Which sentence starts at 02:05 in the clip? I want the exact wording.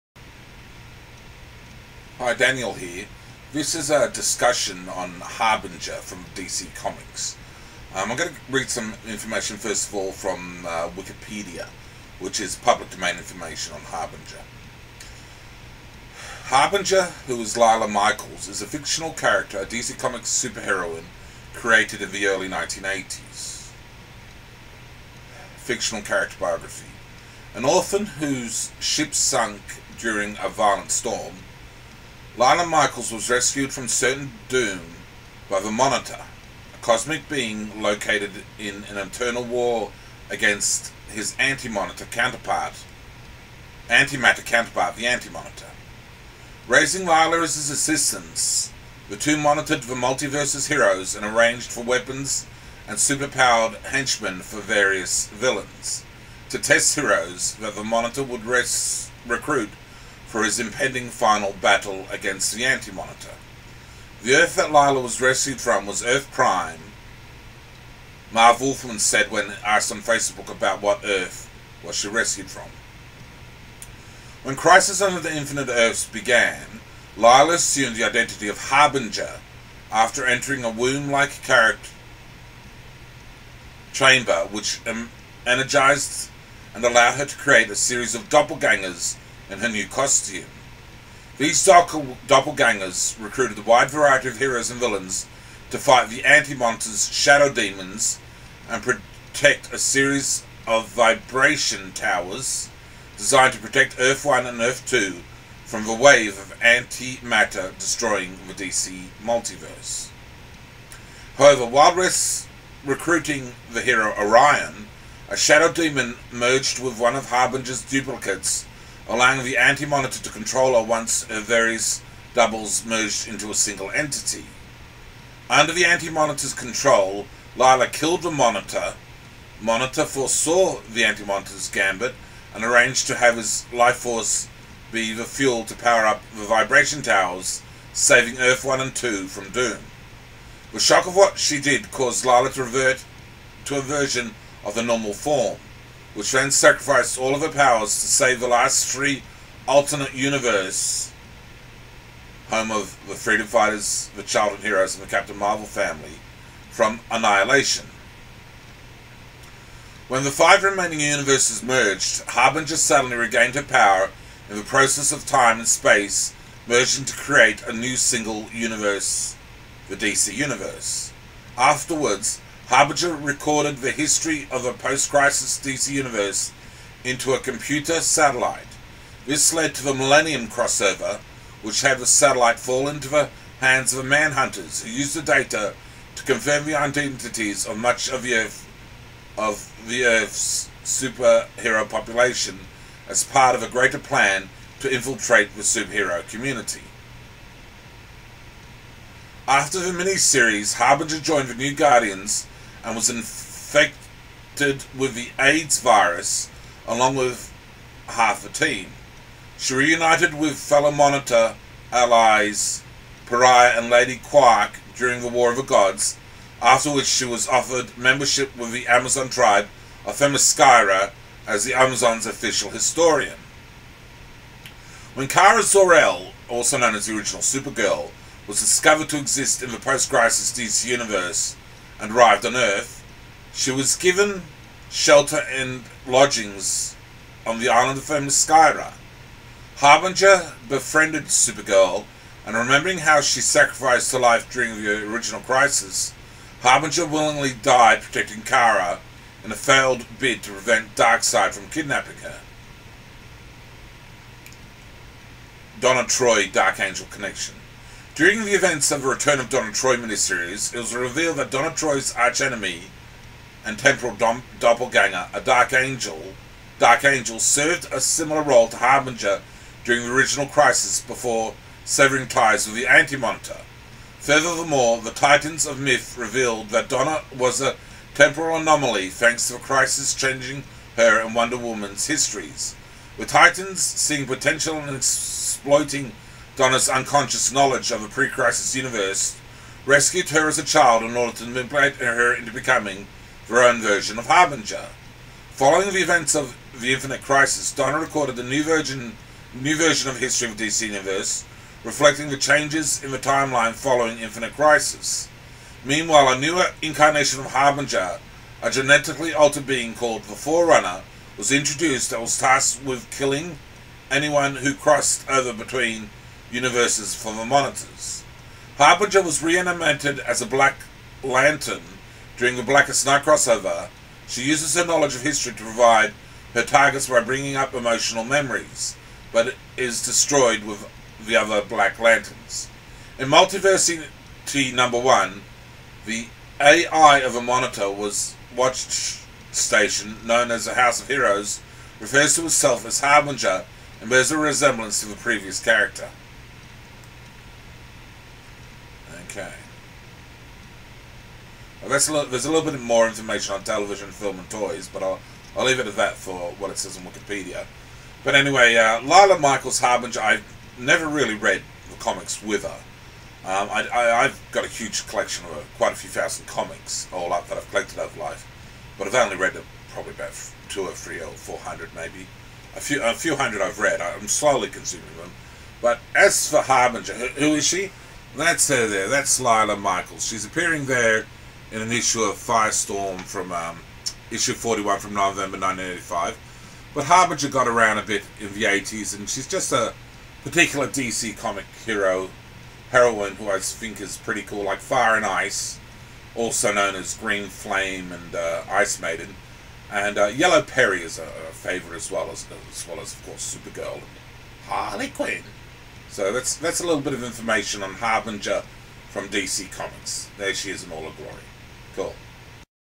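Under the anti-monitor's control, Lila killed the monitor.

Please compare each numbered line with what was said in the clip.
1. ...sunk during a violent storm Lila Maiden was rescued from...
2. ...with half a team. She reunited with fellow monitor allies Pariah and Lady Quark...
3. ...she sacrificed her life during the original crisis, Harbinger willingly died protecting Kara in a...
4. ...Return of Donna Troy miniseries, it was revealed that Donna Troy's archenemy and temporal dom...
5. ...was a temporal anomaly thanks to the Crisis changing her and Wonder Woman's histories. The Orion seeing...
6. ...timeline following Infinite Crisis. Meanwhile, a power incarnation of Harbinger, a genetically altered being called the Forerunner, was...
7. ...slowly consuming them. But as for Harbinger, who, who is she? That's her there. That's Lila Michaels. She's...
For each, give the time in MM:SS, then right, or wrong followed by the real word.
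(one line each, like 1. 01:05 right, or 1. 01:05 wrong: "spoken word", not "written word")
1. 00:29 wrong: "Michaels", not "Maiden"
2. 03:27 right
3. 04:03 right
4. 04:19 right
5. 04:37 wrong: "Titans", not "Orion"
6. 05:03 wrong: "newer", not "power"
7. 06:14 right.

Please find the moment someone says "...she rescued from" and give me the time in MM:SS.
01:11.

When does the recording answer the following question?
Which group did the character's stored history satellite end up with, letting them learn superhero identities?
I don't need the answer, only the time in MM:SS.
03:04.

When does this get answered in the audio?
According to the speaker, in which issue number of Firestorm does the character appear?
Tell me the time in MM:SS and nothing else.
06:24.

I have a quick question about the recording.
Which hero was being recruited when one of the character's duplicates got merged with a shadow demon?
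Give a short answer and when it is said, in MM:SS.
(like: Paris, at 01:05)
Orion, at 01:54.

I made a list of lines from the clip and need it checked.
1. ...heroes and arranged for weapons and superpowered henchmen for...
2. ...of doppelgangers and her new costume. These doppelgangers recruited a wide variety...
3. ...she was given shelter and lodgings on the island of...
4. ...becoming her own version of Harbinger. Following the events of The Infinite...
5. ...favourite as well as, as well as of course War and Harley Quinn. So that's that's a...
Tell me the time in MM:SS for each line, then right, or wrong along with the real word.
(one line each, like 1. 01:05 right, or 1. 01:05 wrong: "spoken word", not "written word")
1. 00:50 right
2. 01:28 right
3. 03:53 right
4. 04:52 right
5. 06:41 wrong: "Supergirl", not "War".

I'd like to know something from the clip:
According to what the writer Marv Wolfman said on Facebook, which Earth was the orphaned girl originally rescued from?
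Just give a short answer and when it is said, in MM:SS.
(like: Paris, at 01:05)
Earth Prime, at 01:06.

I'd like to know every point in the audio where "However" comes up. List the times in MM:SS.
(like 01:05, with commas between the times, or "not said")
01:51.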